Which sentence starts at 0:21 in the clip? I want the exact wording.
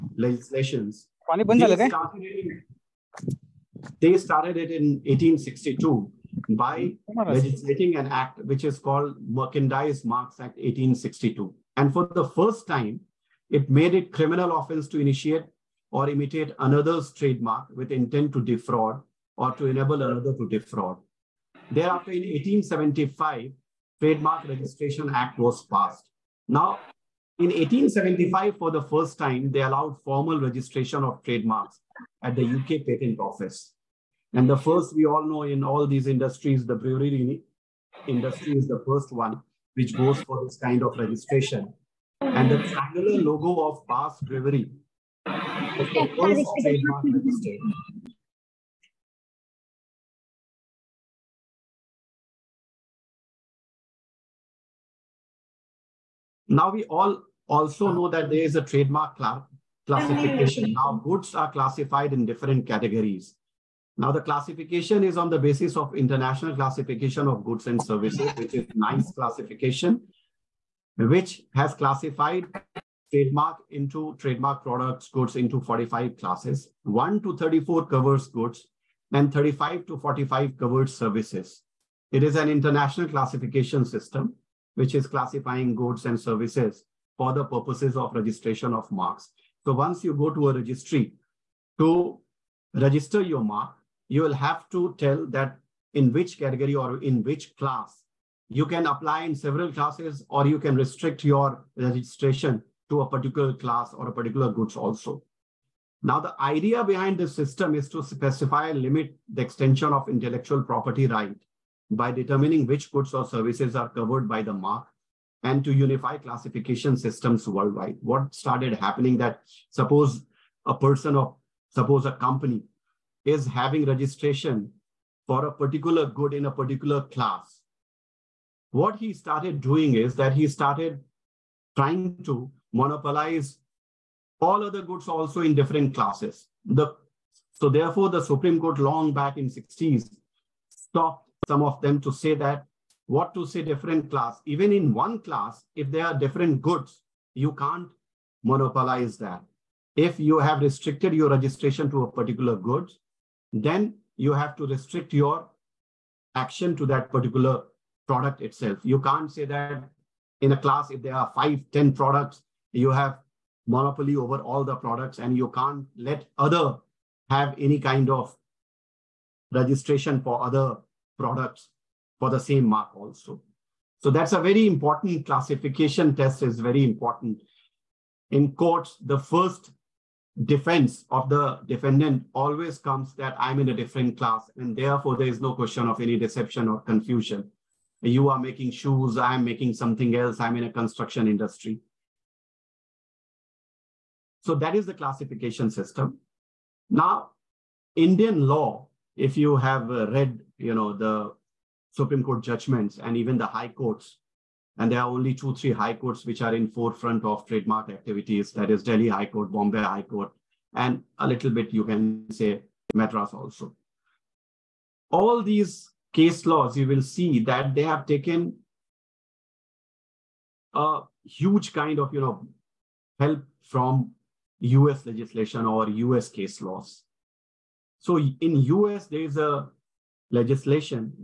Thereafter, in 1875, Trademark Registration Act was passed.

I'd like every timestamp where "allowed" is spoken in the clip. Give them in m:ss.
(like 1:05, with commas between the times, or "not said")
0:29.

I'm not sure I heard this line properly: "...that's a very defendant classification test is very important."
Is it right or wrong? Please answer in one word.
wrong.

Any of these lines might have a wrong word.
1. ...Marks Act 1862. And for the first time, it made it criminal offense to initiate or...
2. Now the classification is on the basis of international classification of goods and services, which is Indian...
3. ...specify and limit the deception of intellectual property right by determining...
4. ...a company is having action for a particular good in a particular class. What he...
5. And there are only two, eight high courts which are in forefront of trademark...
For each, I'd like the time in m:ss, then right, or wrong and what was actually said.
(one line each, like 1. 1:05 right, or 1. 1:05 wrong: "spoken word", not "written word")
1. 0:10 right
2. 1:03 wrong: "NICE", not "Indian"
3. 1:48 wrong: "extension", not "deception"
4. 2:02 wrong: "registration", not "action"
5. 3:24 wrong: "three", not "eight".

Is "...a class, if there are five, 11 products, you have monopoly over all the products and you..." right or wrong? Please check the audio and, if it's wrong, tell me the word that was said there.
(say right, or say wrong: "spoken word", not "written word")
wrong: "10", not "11".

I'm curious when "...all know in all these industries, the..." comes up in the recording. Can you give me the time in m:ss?
0:35.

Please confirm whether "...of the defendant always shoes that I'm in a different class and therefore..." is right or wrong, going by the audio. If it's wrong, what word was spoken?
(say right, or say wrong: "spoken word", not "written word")
wrong: "comes", not "shoes".